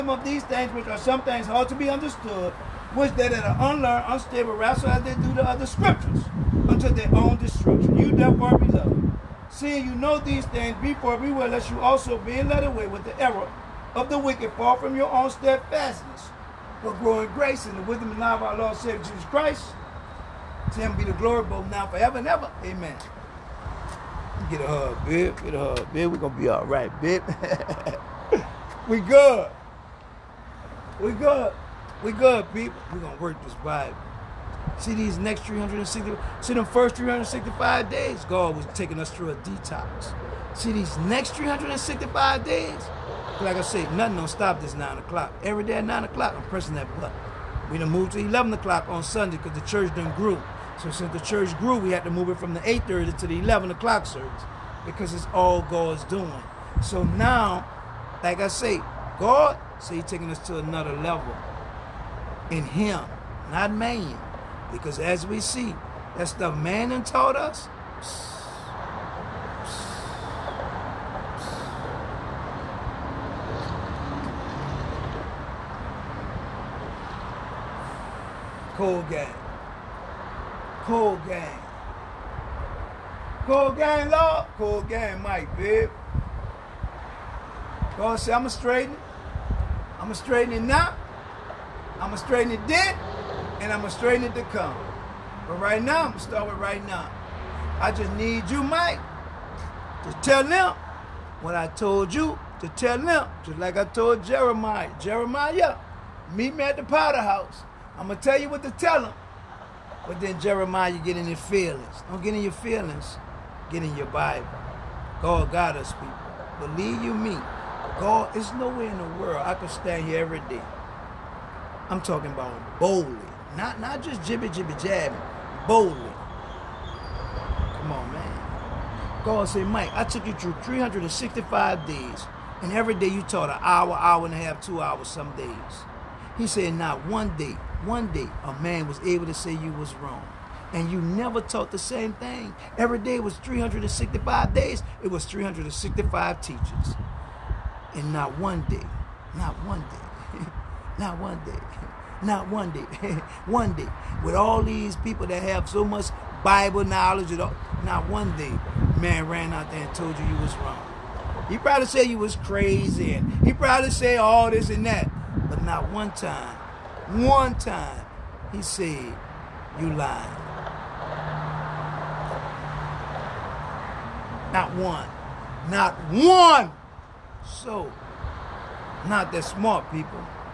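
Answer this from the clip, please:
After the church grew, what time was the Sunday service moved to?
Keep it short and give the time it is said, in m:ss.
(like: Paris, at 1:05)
11 o'clock, at 0:48.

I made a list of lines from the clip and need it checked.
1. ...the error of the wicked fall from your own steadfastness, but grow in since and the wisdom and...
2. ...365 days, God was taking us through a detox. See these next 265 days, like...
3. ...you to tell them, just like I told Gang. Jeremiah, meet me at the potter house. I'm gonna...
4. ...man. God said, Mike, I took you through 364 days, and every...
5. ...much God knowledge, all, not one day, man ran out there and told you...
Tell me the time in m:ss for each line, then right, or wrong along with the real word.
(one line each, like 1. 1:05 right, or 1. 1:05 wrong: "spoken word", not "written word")
1. 0:13 wrong: "grace", not "since"
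2. 0:36 wrong: "365", not "265"
3. 1:42 wrong: "Jeremiah", not "Gang"
4. 2:08 wrong: "365", not "364"
5. 2:35 wrong: "Bible", not "God".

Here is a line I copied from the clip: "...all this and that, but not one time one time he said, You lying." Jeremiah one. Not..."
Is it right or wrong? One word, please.
wrong.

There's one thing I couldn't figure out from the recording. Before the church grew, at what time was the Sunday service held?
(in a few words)
8:30.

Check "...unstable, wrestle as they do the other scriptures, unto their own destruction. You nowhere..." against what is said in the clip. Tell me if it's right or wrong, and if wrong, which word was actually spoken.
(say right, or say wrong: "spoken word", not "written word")
wrong: "therefore", not "nowhere".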